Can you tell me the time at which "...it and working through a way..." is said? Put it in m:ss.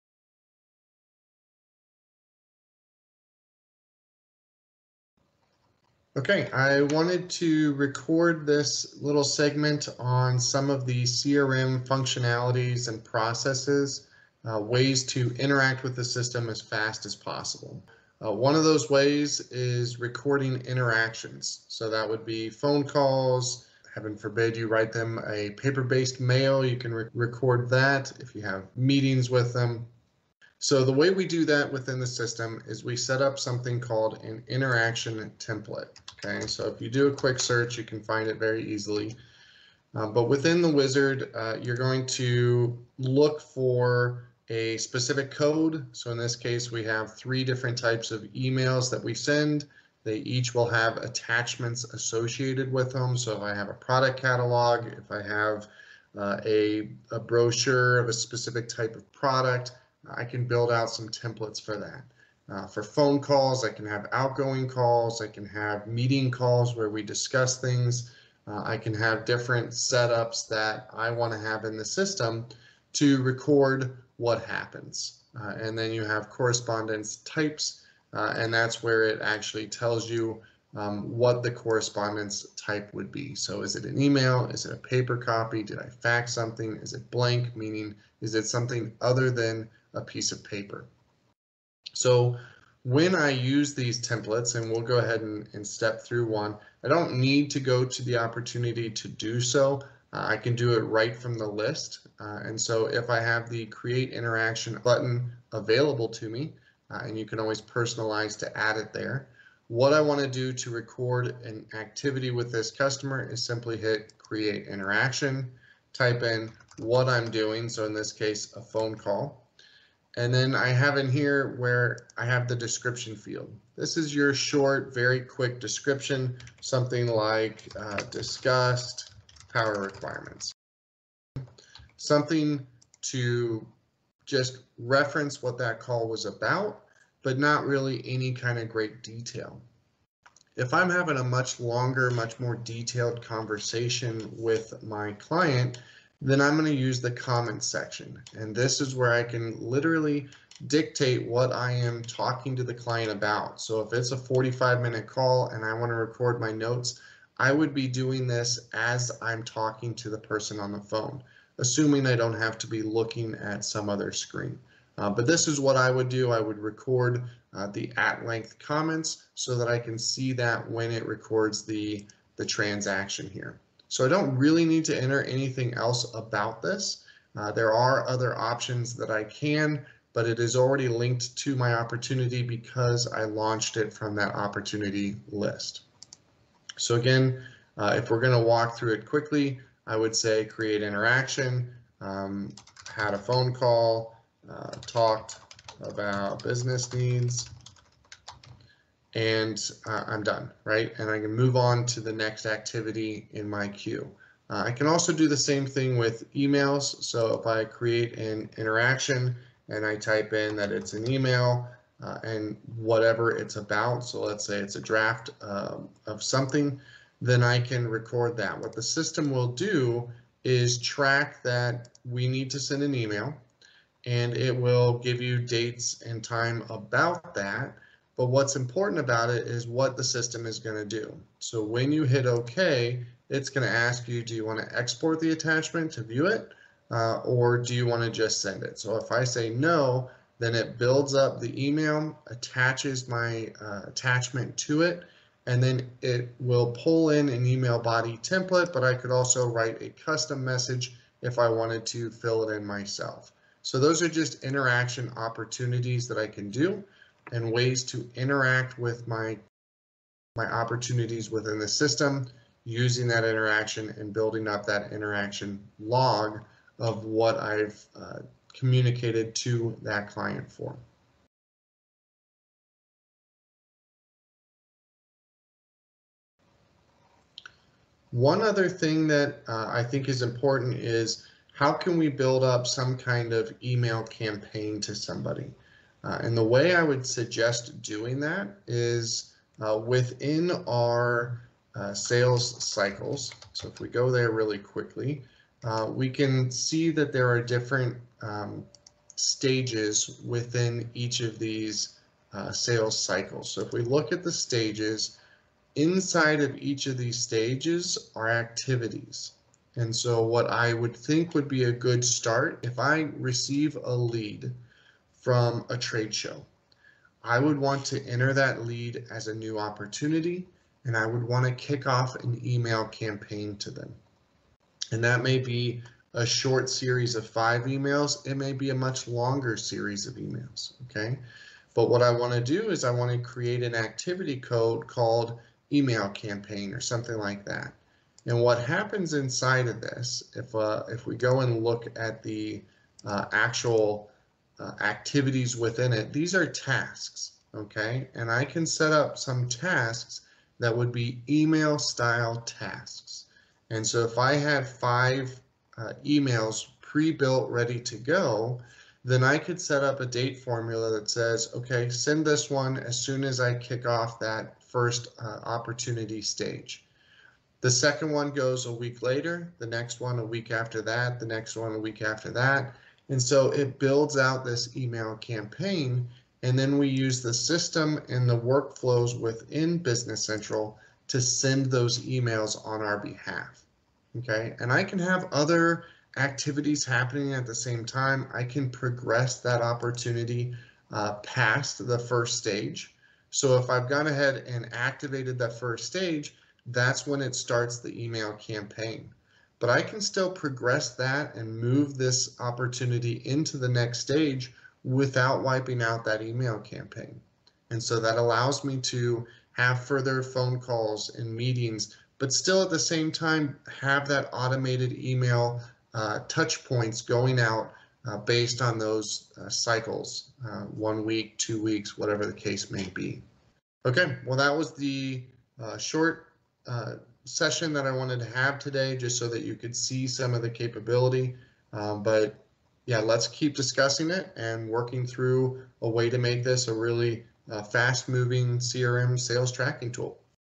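7:14.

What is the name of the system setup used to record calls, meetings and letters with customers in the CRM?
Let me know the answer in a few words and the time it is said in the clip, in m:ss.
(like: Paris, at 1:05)
interaction template, at 0:34.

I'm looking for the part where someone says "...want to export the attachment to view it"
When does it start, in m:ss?
3:54.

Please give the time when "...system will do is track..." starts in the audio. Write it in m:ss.
3:38.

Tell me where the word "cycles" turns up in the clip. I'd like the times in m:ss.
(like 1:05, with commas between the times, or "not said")
4:52, 5:02, 6:59.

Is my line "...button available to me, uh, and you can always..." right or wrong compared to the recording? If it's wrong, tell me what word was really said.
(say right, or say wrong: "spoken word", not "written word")
right.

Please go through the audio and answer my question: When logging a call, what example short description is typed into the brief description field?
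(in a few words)
discussed power requirements.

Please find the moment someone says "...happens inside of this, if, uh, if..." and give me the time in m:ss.
5:38.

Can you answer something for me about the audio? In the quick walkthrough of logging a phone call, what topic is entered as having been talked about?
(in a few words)
business needs.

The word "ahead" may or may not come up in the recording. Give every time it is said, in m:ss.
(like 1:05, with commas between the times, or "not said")
1:34, 6:34.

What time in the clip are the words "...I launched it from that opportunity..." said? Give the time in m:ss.
3:03.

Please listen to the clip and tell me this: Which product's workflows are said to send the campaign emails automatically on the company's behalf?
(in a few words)
Business Central.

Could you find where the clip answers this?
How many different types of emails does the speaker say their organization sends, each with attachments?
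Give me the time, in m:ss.
0:47.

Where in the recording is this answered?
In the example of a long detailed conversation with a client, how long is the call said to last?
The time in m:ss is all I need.
2:34.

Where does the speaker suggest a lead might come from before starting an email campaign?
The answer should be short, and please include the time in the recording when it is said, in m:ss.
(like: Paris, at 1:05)
a trade show, at 5:15.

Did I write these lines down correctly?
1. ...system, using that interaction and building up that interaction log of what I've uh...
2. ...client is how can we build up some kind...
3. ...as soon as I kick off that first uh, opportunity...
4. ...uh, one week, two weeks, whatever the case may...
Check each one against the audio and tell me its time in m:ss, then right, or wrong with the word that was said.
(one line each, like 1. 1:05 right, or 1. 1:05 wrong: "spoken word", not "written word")
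1. 4:21 right
2. 4:40 wrong: "important", not "client"
3. 6:02 right
4. 7:00 right.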